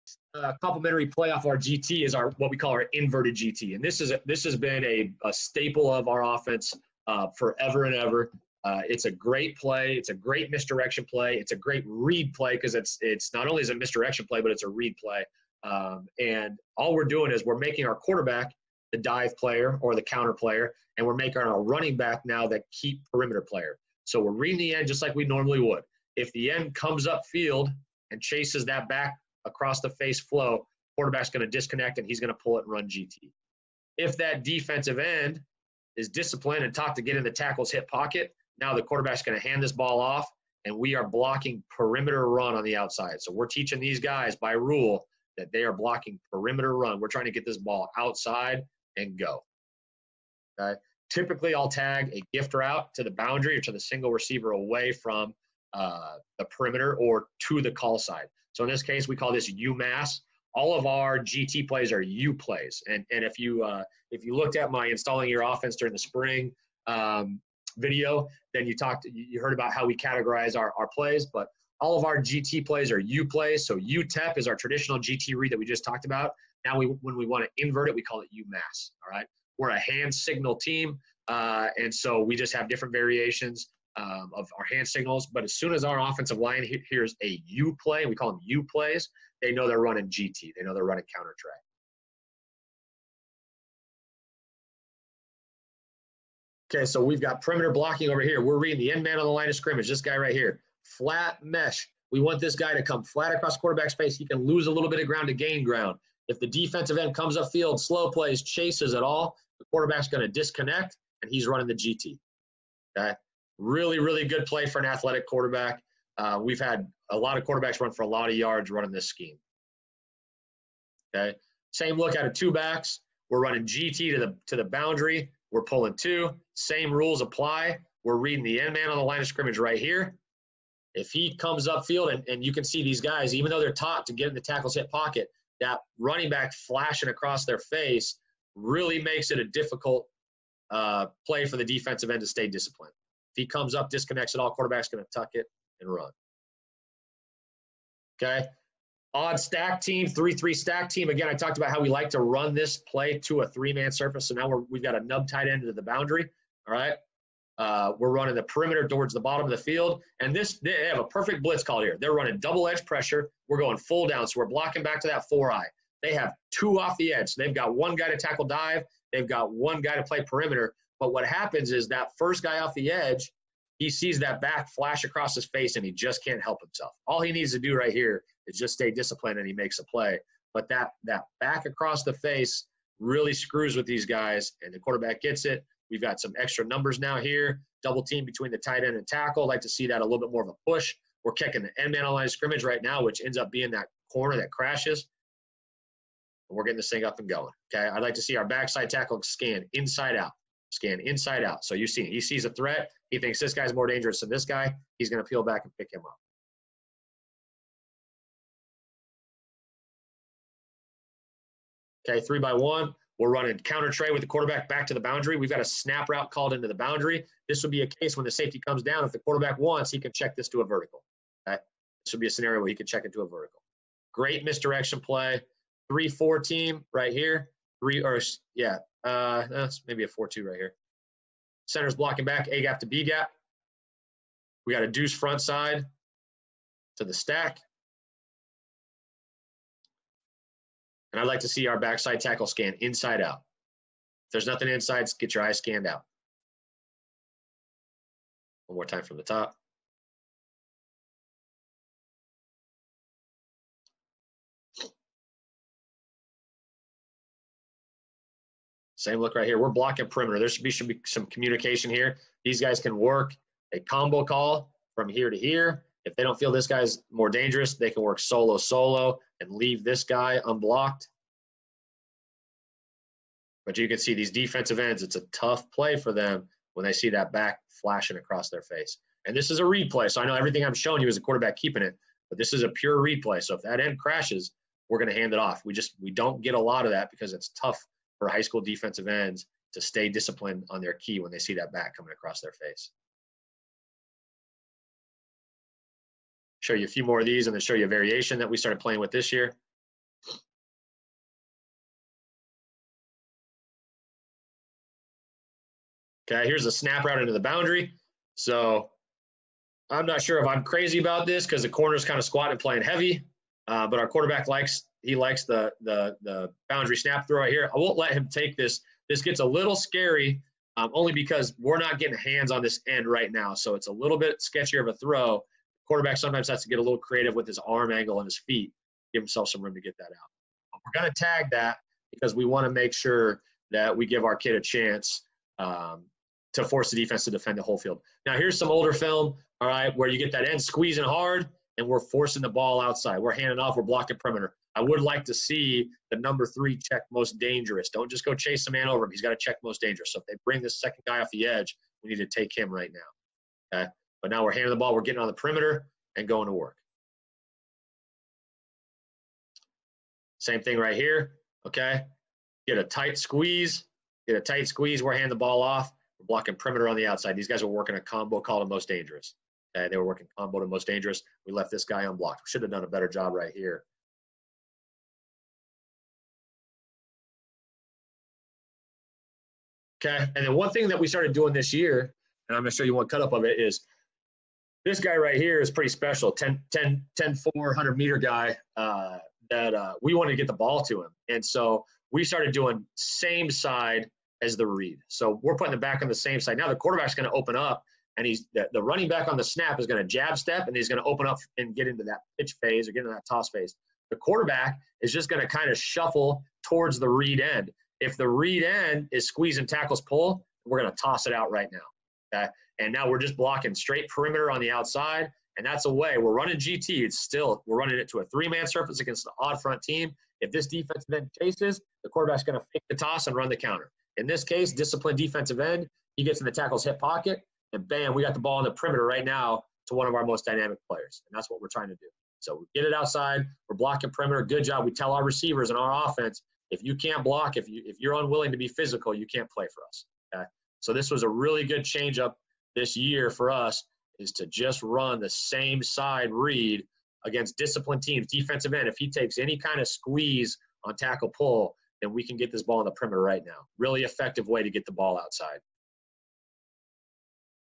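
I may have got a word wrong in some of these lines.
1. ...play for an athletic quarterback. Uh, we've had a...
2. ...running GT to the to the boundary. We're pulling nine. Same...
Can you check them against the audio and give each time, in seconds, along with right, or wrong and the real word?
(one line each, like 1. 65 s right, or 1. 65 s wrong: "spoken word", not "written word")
1. 114 s right
2. 123 s wrong: "two", not "nine".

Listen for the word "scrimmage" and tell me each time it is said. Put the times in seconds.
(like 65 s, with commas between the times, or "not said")
99 s, 129 s, 192 s.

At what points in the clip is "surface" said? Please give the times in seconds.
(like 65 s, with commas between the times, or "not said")
153 s, 418 s.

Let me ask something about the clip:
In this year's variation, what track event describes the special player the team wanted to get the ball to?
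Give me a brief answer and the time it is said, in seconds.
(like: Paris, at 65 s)
400 meter, at 387 s.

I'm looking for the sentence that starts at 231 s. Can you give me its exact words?
Center's blocking back, A gap to B gap.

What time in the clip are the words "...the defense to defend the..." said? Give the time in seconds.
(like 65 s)
336 s.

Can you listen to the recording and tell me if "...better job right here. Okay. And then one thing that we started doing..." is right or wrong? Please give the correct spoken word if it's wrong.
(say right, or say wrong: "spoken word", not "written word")
right.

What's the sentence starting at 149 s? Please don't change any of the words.
Odd stack team, 3 3 stack team.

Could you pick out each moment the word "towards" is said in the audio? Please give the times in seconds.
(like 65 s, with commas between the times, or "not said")
158 s, 406 s.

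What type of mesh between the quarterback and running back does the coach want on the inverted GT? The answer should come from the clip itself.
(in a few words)
Flat mesh.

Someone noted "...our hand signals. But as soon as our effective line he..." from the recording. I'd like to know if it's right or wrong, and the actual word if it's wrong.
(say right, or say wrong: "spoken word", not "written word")
wrong: "offensive", not "effective".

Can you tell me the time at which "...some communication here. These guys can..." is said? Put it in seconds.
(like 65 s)
261 s.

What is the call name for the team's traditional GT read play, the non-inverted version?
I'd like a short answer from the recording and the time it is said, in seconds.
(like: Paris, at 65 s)
UTEP, at 73 s.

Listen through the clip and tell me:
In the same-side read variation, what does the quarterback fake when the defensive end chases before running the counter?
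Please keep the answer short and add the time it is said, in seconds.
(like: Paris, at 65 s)
The toss, at 422 s.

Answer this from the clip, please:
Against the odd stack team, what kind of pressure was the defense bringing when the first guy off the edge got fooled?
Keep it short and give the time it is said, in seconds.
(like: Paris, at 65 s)
Double edge pressure, at 162 s.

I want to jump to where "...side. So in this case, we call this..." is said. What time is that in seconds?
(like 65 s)
57 s.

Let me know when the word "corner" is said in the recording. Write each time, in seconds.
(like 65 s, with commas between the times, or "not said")
194 s, 311 s.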